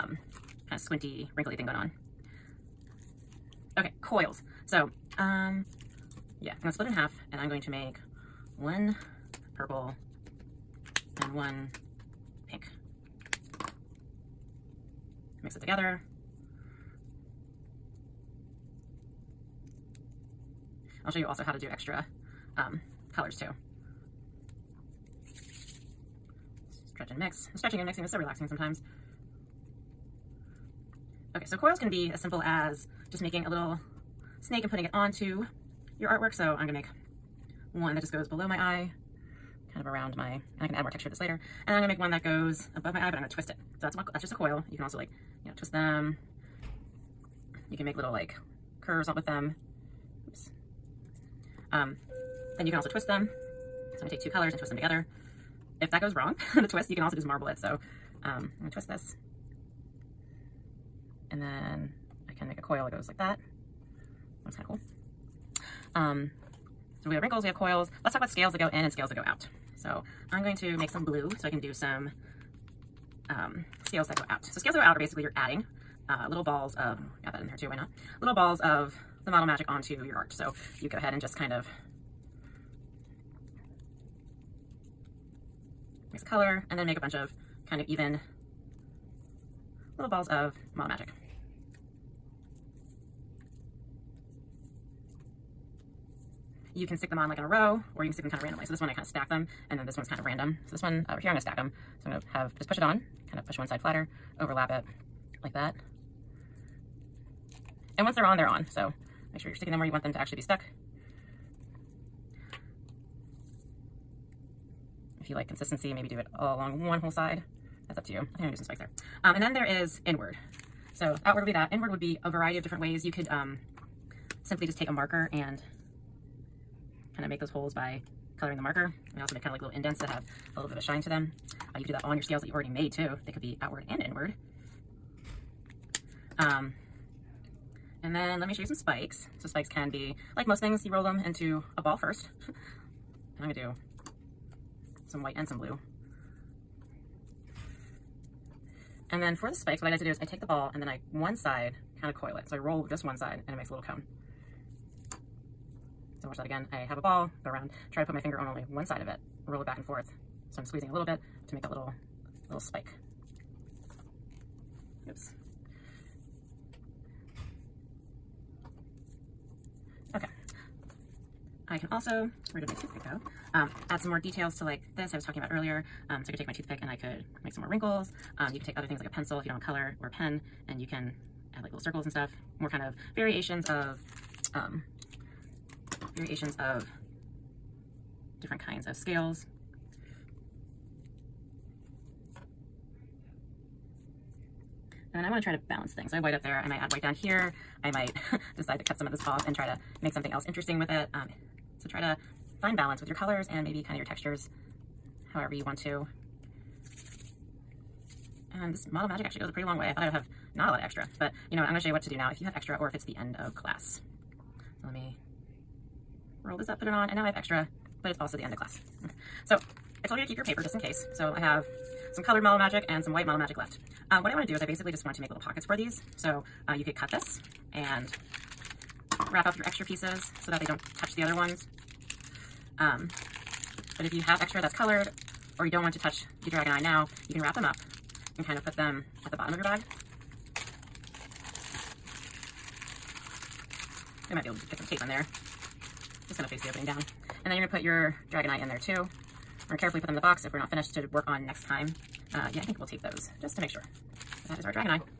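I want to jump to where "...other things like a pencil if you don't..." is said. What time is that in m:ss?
2:58.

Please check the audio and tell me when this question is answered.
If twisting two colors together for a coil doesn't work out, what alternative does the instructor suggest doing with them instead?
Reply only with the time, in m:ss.
0:57.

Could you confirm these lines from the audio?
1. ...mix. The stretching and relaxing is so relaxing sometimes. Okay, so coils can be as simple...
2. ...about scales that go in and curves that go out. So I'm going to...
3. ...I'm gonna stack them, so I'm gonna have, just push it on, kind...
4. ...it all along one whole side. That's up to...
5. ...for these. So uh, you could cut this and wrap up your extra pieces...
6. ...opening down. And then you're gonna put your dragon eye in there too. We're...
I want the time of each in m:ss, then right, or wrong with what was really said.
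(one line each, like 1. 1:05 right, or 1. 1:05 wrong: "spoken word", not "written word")
1. 0:27 wrong: "mixing", not "relaxing"
2. 1:08 wrong: "scales", not "curves"
3. 1:41 right
4. 1:56 right
5. 3:45 right
6. 4:06 right.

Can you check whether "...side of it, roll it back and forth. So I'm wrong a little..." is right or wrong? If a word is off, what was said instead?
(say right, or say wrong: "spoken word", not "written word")
wrong: "squeezing", not "wrong".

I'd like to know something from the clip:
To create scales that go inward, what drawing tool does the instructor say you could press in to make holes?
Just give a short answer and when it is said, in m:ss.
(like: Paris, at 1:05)
a marker, at 2:04.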